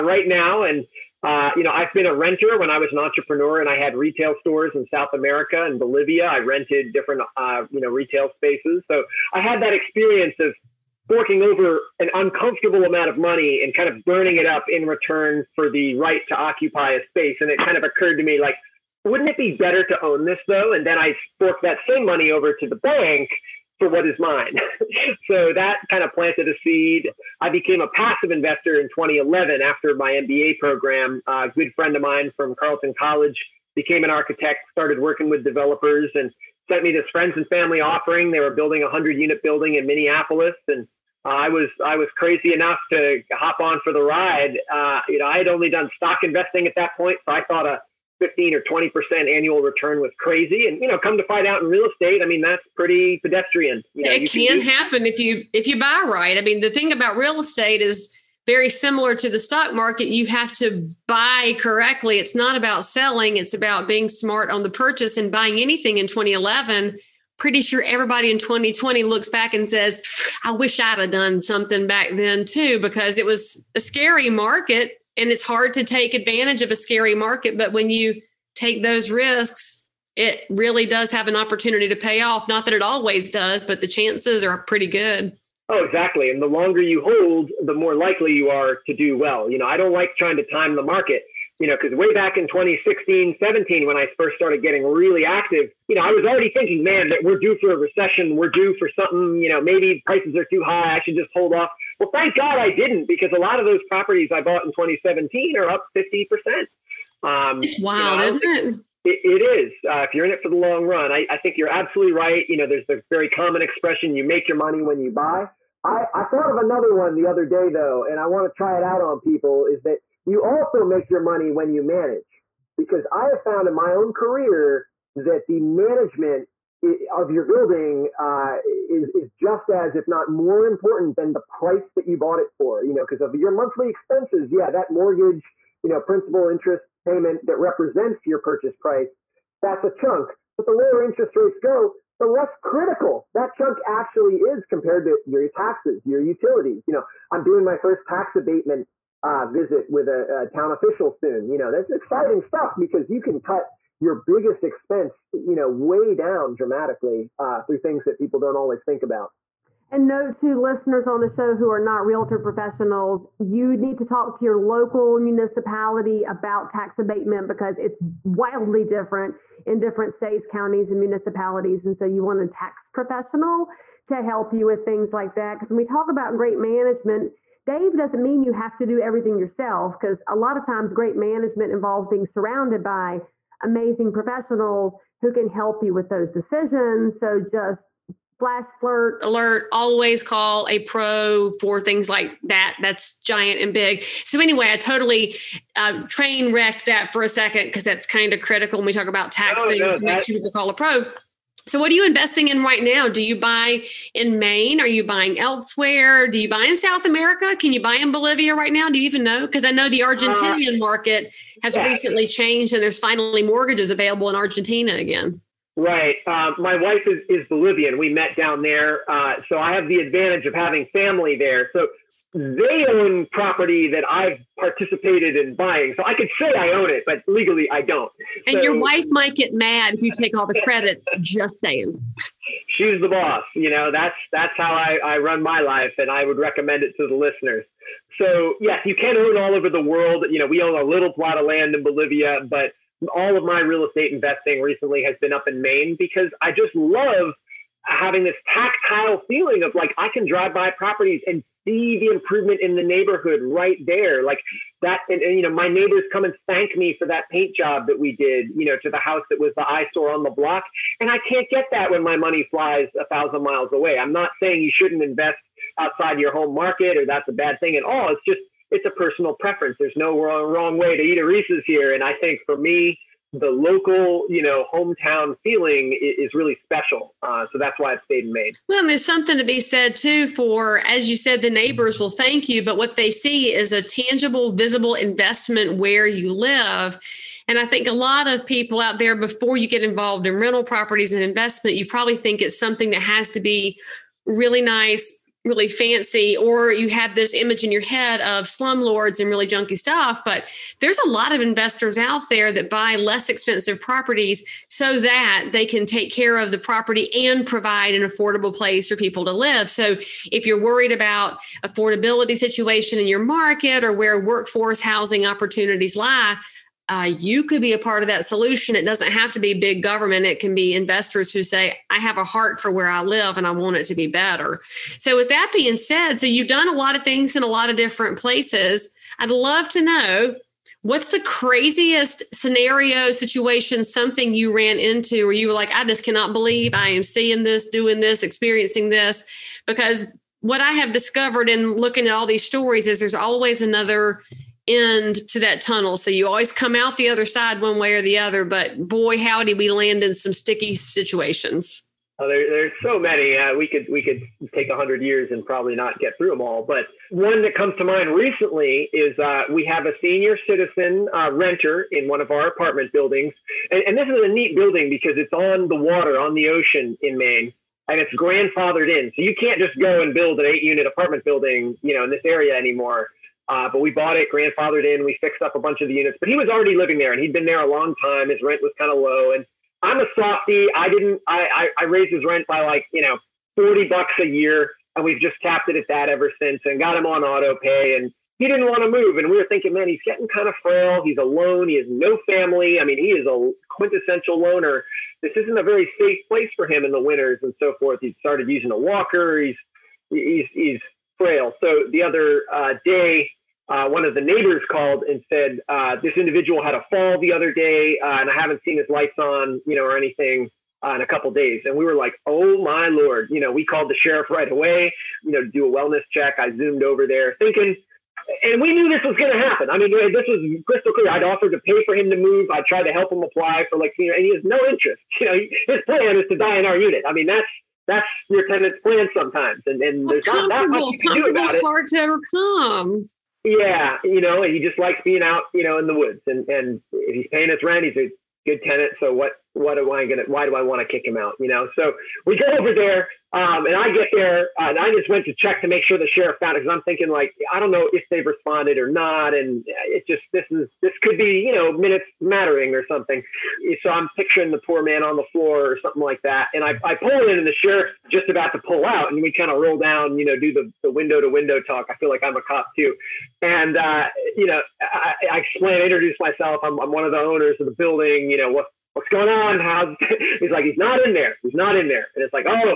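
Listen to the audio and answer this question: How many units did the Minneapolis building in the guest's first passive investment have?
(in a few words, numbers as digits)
100.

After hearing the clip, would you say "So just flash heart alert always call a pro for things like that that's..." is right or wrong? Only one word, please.
wrong.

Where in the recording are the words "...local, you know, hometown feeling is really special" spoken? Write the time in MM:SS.
04:33.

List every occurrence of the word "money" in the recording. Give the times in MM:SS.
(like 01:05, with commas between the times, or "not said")
00:13, 00:22, 01:54, 02:01, 04:22.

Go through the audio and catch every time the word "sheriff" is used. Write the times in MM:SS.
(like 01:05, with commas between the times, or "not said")
06:53, 07:26, 07:37.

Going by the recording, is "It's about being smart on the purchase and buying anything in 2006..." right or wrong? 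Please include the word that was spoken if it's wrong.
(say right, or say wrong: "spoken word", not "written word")
wrong: "2011", not "2006".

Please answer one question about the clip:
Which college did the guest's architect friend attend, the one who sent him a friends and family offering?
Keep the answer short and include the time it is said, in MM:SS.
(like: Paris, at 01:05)
Carleton College, at 00:32.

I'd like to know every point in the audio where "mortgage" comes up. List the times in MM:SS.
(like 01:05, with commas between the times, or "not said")
02:14, 03:33.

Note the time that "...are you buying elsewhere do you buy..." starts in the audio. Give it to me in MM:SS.
03:24.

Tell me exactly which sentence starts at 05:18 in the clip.
It doesn't have to be big government.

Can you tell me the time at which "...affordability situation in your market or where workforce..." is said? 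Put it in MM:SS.
05:11.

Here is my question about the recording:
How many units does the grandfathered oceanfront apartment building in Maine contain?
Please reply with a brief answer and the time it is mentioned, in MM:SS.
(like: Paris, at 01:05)
8, at 06:10.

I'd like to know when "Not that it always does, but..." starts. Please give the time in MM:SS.
01:22.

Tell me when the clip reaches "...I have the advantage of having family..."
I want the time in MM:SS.
03:39.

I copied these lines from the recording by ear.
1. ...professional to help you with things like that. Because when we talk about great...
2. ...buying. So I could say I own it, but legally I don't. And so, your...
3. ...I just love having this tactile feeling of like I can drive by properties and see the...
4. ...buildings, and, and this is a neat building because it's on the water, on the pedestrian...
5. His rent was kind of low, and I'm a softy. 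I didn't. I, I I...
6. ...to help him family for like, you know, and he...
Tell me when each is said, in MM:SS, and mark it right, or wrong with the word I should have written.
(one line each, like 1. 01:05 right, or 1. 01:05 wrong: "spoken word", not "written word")
1. 02:52 right
2. 03:45 right
3. 04:06 right
4. 06:02 wrong: "ocean", not "pedestrian"
5. 06:18 right
6. 07:02 wrong: "apply", not "family".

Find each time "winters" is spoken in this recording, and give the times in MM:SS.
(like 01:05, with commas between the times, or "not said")
06:37.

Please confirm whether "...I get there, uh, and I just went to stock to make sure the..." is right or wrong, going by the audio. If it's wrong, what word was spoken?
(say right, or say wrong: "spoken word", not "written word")
wrong: "check", not "stock".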